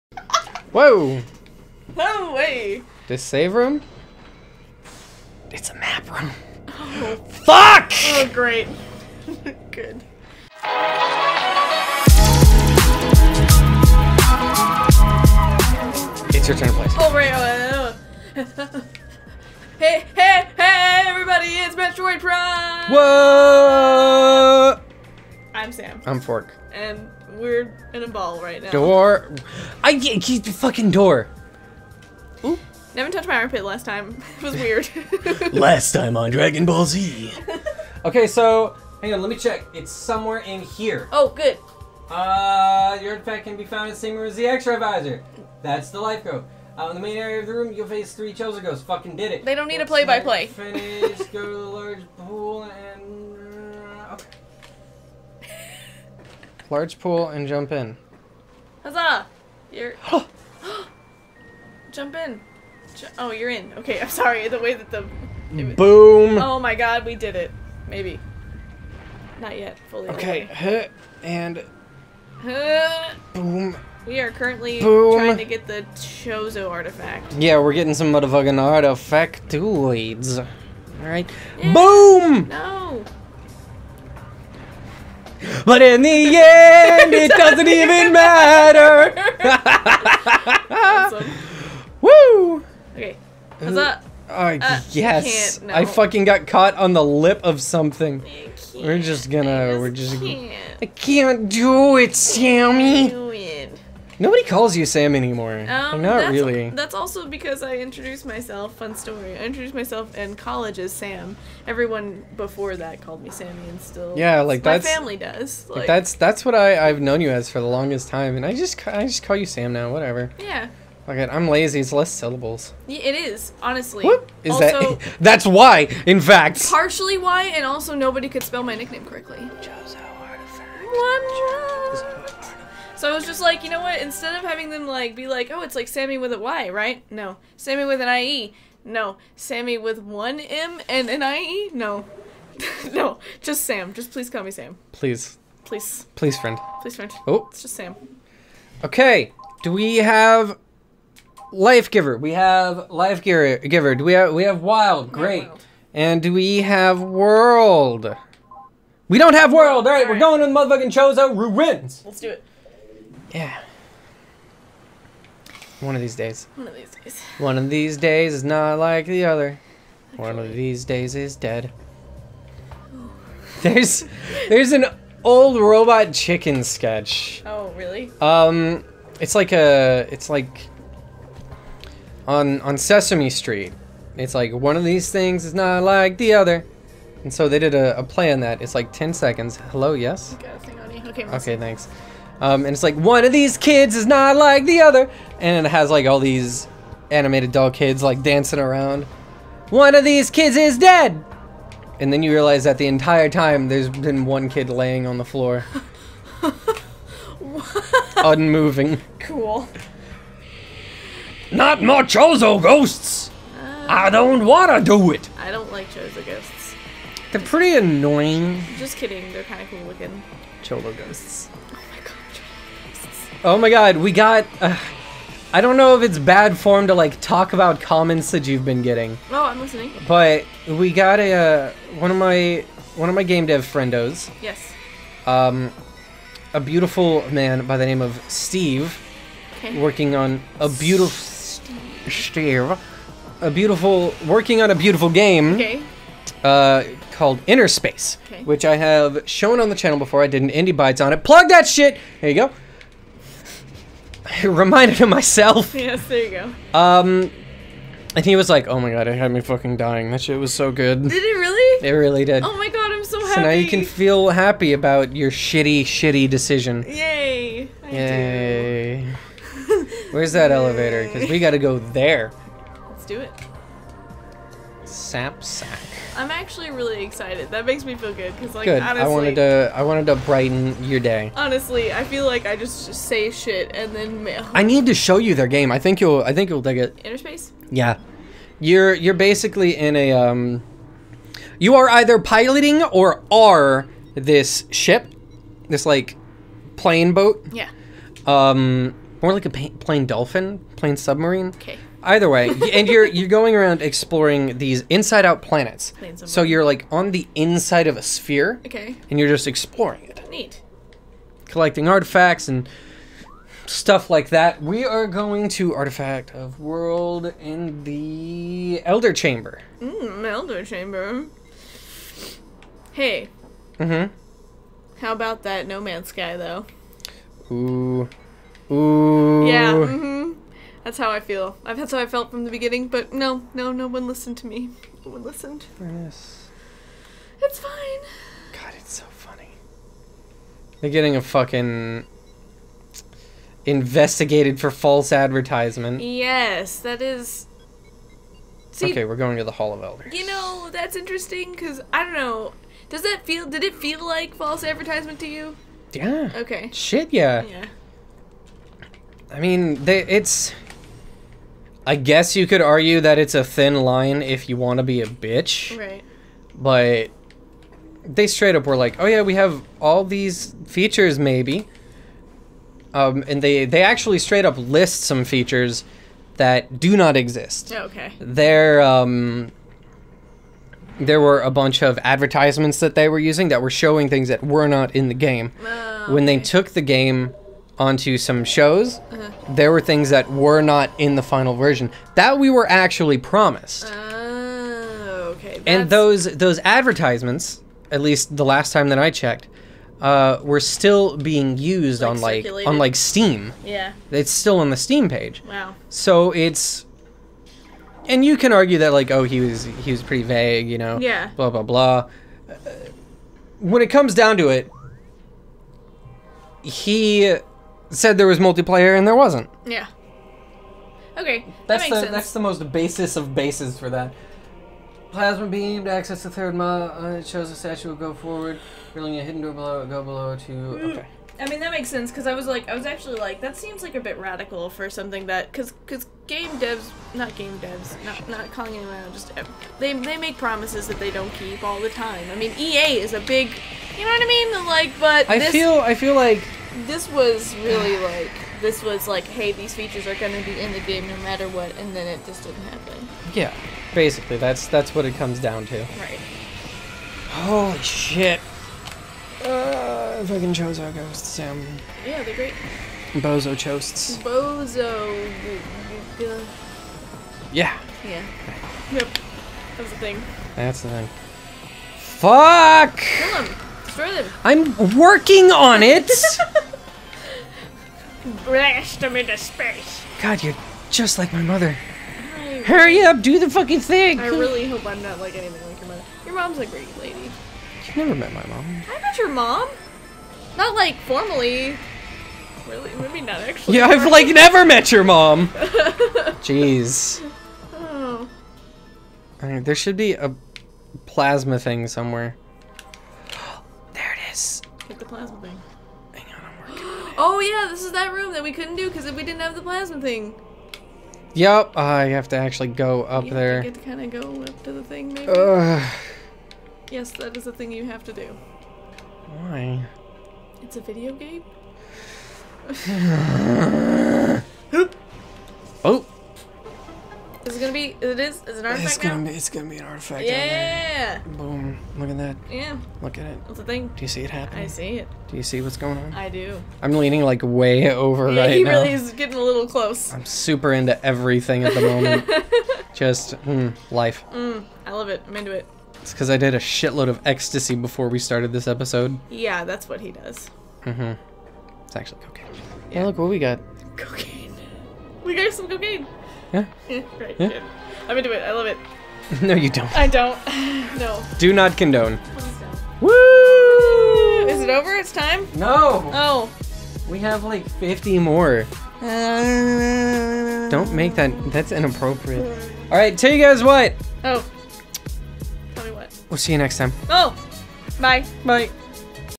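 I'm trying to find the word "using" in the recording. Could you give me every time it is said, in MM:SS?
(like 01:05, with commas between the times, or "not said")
06:23.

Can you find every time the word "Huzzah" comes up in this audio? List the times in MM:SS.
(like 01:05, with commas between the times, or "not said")
00:58.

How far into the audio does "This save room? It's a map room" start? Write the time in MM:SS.
00:03.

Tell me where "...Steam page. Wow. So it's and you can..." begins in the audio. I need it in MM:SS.
06:44.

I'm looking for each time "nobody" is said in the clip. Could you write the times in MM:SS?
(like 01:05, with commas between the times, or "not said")
01:44, 02:07.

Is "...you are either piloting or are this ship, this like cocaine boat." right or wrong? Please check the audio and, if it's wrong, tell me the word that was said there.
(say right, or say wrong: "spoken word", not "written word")
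wrong: "plane", not "cocaine".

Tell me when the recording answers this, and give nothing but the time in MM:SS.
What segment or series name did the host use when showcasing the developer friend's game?
04:10.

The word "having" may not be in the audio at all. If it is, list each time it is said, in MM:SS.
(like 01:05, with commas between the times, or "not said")
02:14.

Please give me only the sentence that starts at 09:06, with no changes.
It's because I did a shitload of ecstasy before we started this episode.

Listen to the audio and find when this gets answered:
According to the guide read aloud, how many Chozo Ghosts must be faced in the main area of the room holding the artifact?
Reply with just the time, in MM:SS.
00:48.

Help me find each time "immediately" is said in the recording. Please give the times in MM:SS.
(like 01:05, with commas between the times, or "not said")
not said.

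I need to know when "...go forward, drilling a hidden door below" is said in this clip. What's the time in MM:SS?
07:07.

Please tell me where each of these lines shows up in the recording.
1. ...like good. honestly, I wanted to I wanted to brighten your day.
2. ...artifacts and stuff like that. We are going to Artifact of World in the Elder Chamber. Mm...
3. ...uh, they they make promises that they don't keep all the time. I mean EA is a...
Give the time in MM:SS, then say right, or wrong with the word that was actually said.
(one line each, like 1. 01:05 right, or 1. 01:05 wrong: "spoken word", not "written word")
1. 04:38 right
2. 05:11 right
3. 07:19 right.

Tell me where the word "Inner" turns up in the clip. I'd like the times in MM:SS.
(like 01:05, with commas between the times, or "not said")
04:07, 04:47.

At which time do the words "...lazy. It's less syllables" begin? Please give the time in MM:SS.
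02:01.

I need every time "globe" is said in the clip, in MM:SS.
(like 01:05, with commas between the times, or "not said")
not said.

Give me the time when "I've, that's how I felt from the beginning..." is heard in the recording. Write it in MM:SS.
05:31.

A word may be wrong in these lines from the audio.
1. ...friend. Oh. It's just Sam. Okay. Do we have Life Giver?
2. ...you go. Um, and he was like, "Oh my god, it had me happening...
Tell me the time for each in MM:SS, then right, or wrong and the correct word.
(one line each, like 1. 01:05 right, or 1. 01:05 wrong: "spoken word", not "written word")
1. 02:26 right
2. 04:16 wrong: "fucking", not "happening".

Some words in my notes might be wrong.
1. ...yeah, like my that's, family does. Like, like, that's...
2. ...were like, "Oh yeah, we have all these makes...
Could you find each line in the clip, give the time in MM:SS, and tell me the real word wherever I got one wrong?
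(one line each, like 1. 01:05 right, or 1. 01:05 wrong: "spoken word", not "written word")
1. 01:54 right
2. 06:08 wrong: "features", not "makes".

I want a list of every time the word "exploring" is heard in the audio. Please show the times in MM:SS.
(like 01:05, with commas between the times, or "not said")
05:03, 05:09.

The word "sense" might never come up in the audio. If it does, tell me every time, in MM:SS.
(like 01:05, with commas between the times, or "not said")
07:01, 07:11.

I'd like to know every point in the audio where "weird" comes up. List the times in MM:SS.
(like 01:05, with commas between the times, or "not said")
00:34.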